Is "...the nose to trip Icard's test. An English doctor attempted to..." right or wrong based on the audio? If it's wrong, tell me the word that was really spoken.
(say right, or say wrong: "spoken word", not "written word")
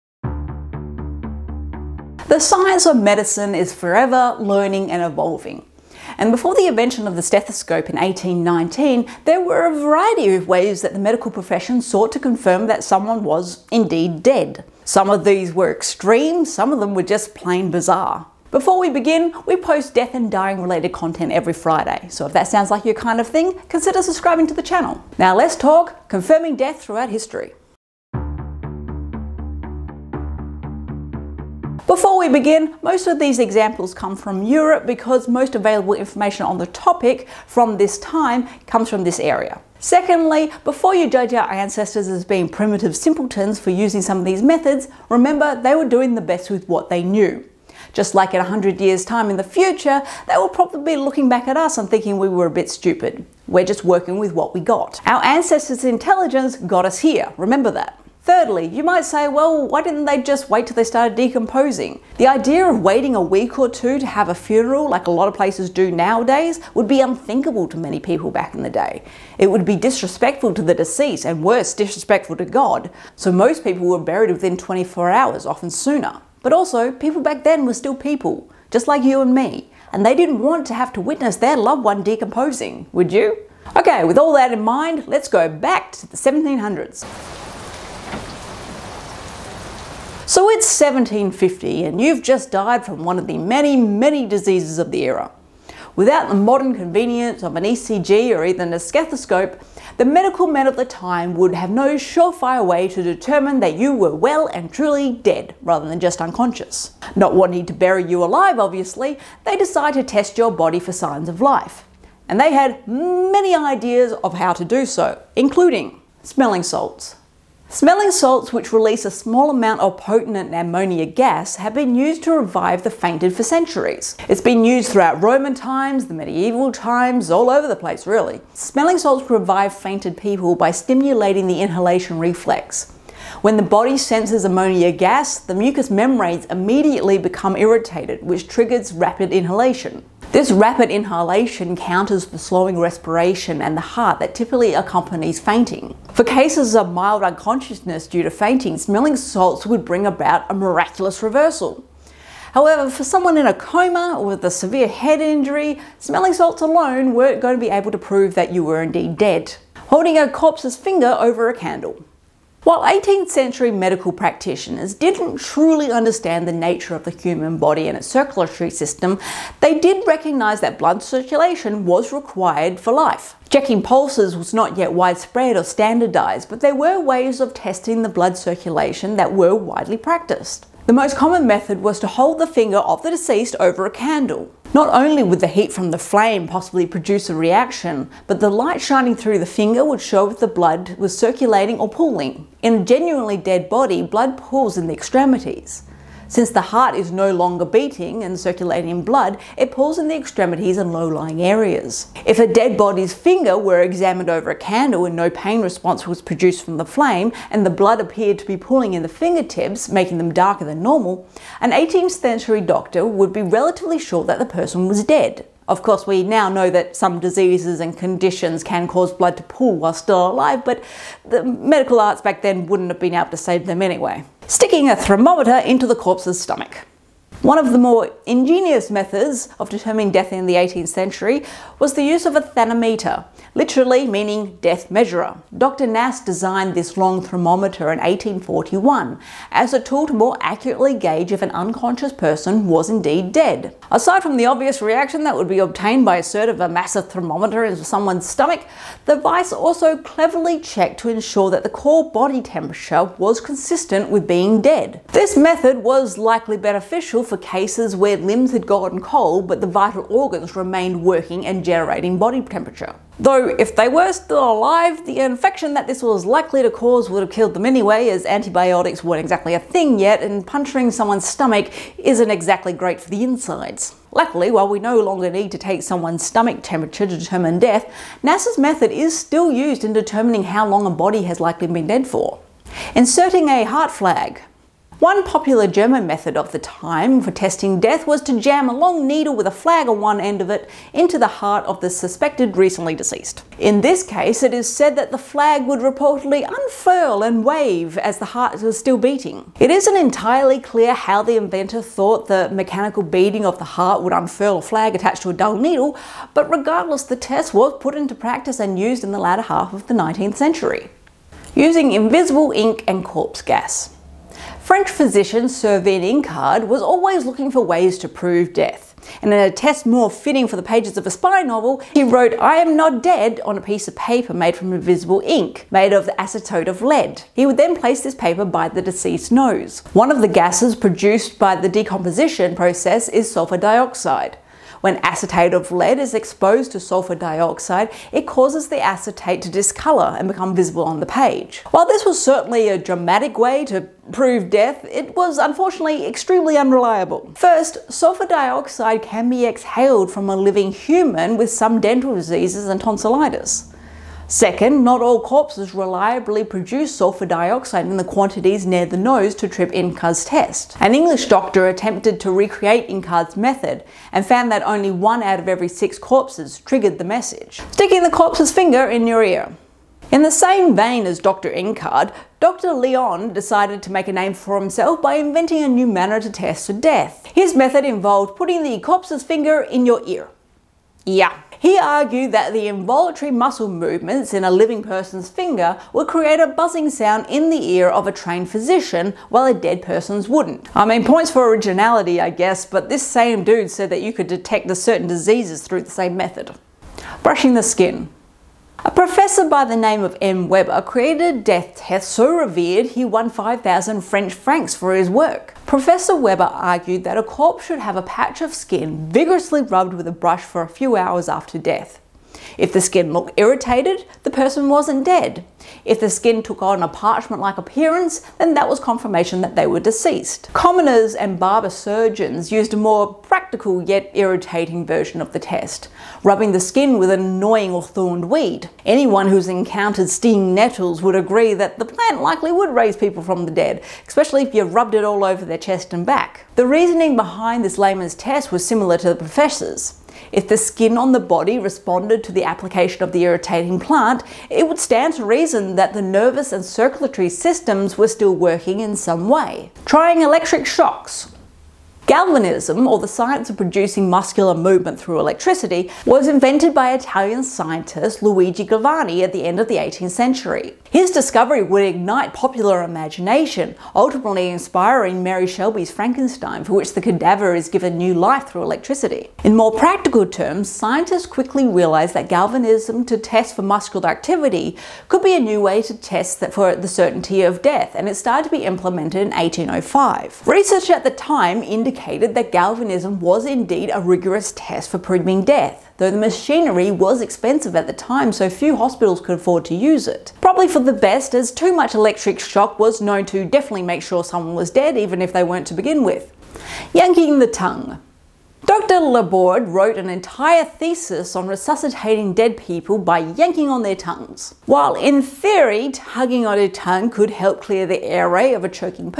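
right.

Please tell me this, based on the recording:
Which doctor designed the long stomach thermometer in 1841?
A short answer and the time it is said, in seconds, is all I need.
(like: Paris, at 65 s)
Dr. Nass, at 235 s.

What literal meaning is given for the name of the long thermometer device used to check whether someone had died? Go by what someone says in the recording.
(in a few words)
death measurer.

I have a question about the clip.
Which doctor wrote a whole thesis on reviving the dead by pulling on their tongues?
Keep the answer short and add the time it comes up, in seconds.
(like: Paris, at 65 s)
Dr. Laborde, at 498 s.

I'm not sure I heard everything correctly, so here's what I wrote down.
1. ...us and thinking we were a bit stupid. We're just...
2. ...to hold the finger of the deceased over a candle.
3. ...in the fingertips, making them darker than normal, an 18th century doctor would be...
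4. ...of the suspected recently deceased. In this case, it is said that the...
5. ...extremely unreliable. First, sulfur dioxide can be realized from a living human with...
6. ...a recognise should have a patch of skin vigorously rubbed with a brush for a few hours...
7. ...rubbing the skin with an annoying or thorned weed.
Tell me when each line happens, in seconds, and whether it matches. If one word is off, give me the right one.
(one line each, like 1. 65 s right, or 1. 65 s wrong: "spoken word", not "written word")
1. 51 s right
2. 182 s right
3. 208 s right
4. 291 s right
5. 346 s wrong: "exhaled", not "realized"
6. 407 s wrong: "corpse", not "recognise"
7. 426 s right.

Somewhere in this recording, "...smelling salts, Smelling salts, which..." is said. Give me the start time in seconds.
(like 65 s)
116 s.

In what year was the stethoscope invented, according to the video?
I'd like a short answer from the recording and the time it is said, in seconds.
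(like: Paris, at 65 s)
1819, at 7 s.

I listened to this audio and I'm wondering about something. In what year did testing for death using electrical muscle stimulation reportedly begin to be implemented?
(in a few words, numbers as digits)
1805.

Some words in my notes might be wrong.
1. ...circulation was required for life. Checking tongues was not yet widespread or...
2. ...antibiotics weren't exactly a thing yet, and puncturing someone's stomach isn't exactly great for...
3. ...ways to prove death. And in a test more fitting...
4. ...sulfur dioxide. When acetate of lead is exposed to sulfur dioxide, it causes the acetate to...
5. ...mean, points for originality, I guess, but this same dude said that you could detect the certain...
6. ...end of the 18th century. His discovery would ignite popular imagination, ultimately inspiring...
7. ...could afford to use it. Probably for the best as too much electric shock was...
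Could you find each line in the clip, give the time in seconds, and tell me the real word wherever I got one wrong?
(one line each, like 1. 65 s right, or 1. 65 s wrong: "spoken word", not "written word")
1. 171 s wrong: "pulses", not "tongues"
2. 268 s right
3. 317 s right
4. 333 s right
5. 390 s right
6. 459 s right
7. 489 s right.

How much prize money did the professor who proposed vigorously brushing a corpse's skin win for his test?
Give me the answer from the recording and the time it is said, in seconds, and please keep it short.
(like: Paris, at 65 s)
5,000 French francs, at 403 s.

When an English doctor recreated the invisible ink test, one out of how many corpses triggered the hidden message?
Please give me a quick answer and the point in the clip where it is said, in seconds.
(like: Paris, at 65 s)
6, at 365 s.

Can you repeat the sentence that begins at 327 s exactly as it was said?
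He would then place this paper by the deceased's nose.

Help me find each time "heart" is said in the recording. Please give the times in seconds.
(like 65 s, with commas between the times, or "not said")
143 s, 196 s, 283 s, 291 s, 298 s, 303 s.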